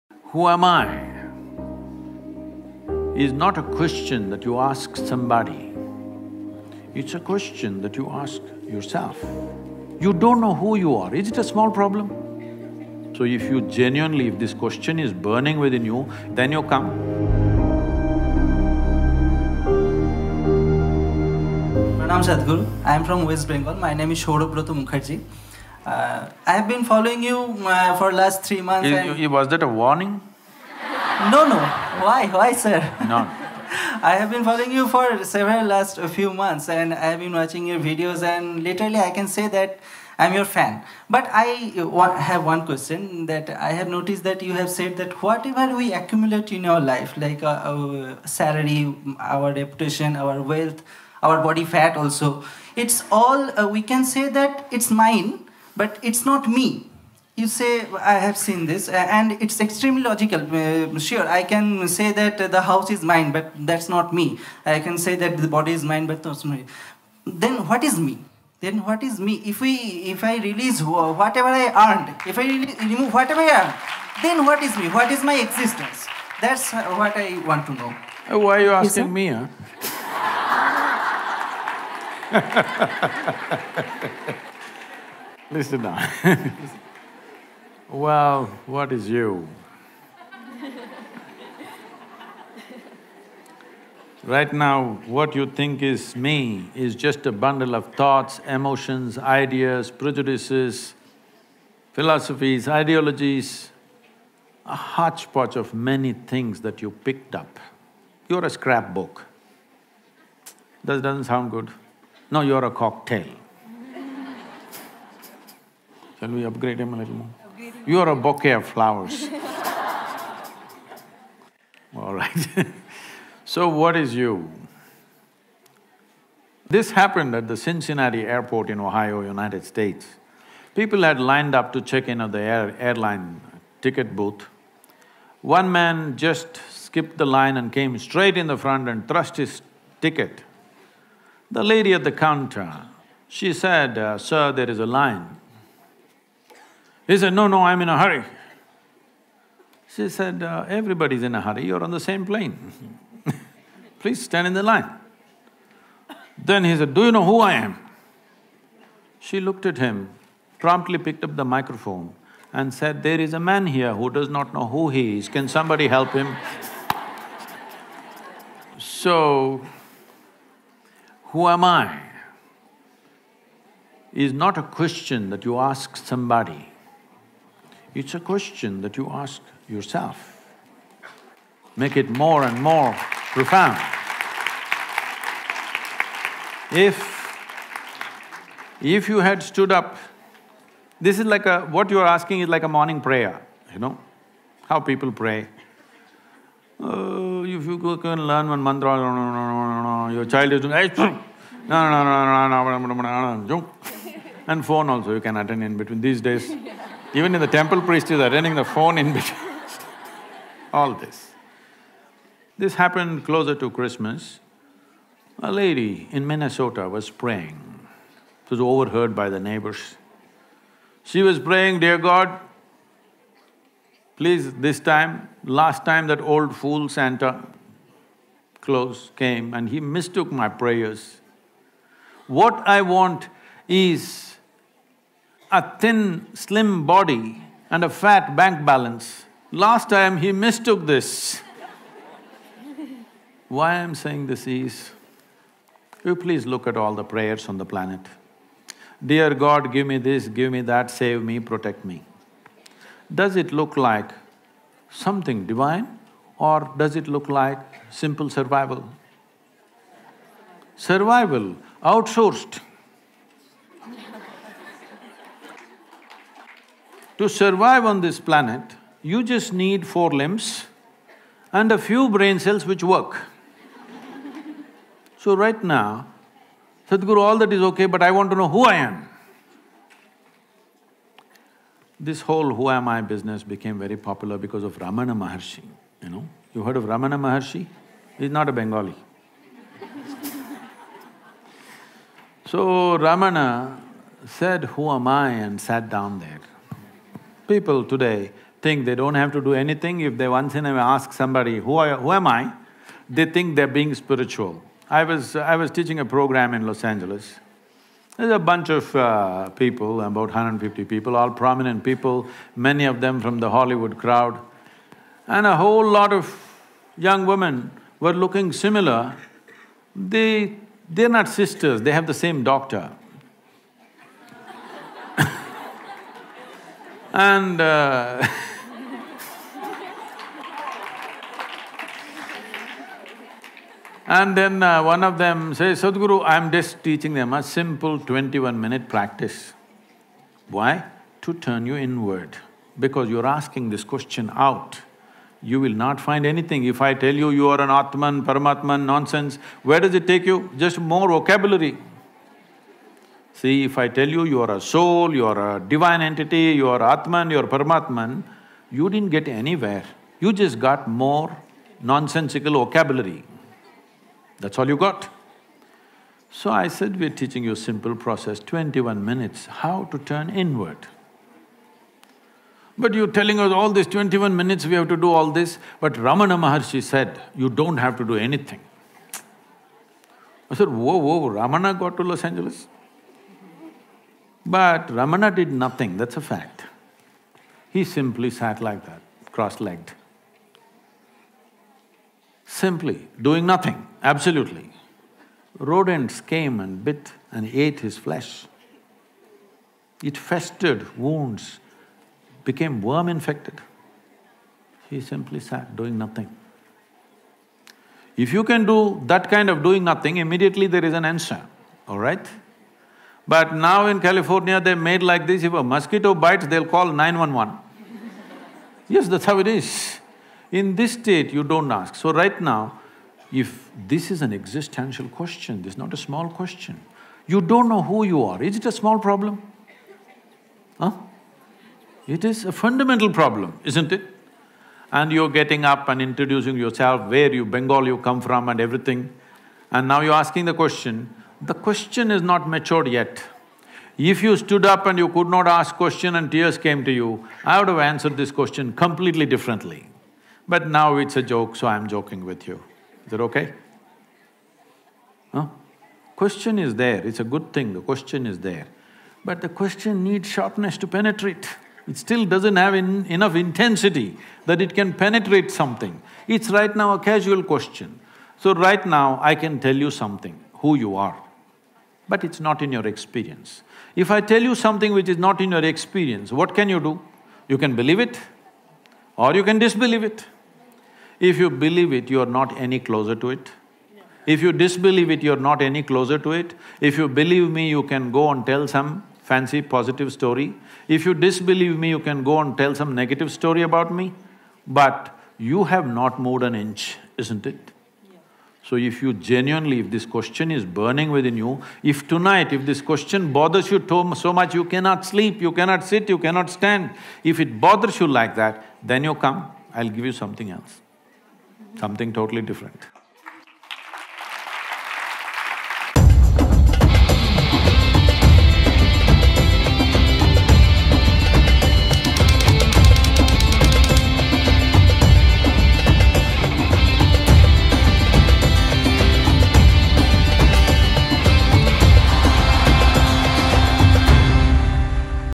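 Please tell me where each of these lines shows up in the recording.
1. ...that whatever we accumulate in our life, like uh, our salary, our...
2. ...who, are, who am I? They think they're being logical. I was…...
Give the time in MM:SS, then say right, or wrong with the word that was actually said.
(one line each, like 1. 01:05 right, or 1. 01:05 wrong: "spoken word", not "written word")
1. 00:44 right
2. 05:01 wrong: "spiritual", not "logical".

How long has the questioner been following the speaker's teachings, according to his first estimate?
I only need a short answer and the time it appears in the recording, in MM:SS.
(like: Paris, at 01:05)
3 months, at 00:28.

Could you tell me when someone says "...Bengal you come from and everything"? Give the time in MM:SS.
07:17.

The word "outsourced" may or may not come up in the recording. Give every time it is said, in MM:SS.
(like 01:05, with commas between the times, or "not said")
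04:21.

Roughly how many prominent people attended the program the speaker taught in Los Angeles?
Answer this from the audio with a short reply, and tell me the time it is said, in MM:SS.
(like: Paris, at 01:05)
150, at 05:10.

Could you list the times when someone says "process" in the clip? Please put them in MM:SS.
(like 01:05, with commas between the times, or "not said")
06:07.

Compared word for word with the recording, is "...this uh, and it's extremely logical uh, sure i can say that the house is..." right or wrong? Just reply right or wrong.
right.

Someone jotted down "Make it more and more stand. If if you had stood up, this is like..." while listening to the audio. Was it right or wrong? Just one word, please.
wrong.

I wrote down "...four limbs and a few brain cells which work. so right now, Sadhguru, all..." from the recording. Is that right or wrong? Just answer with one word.
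right.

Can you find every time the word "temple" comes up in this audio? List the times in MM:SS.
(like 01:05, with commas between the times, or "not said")
03:27.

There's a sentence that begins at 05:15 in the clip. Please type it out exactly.
And a whole lot of young women were looking similar.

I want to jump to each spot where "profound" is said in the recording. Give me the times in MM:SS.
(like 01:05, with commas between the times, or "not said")
03:03.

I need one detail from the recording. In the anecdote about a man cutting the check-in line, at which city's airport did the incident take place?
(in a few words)
Cincinnati.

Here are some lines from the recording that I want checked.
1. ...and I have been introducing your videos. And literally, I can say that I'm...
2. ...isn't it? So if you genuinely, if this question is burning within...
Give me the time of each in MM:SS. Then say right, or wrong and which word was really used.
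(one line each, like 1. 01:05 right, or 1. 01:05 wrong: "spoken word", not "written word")
1. 00:36 wrong: "watching", not "introducing"
2. 08:17 right.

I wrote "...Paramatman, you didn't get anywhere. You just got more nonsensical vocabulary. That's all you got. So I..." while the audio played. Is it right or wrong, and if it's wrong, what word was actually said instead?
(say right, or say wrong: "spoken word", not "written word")
right.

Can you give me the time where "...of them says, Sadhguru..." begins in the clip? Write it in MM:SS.
05:35.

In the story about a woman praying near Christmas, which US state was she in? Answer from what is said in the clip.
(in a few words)
Minnesota.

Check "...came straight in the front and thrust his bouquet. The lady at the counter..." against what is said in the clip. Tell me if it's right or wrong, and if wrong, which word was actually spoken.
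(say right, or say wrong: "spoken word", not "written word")
wrong: "ticket", not "bouquet".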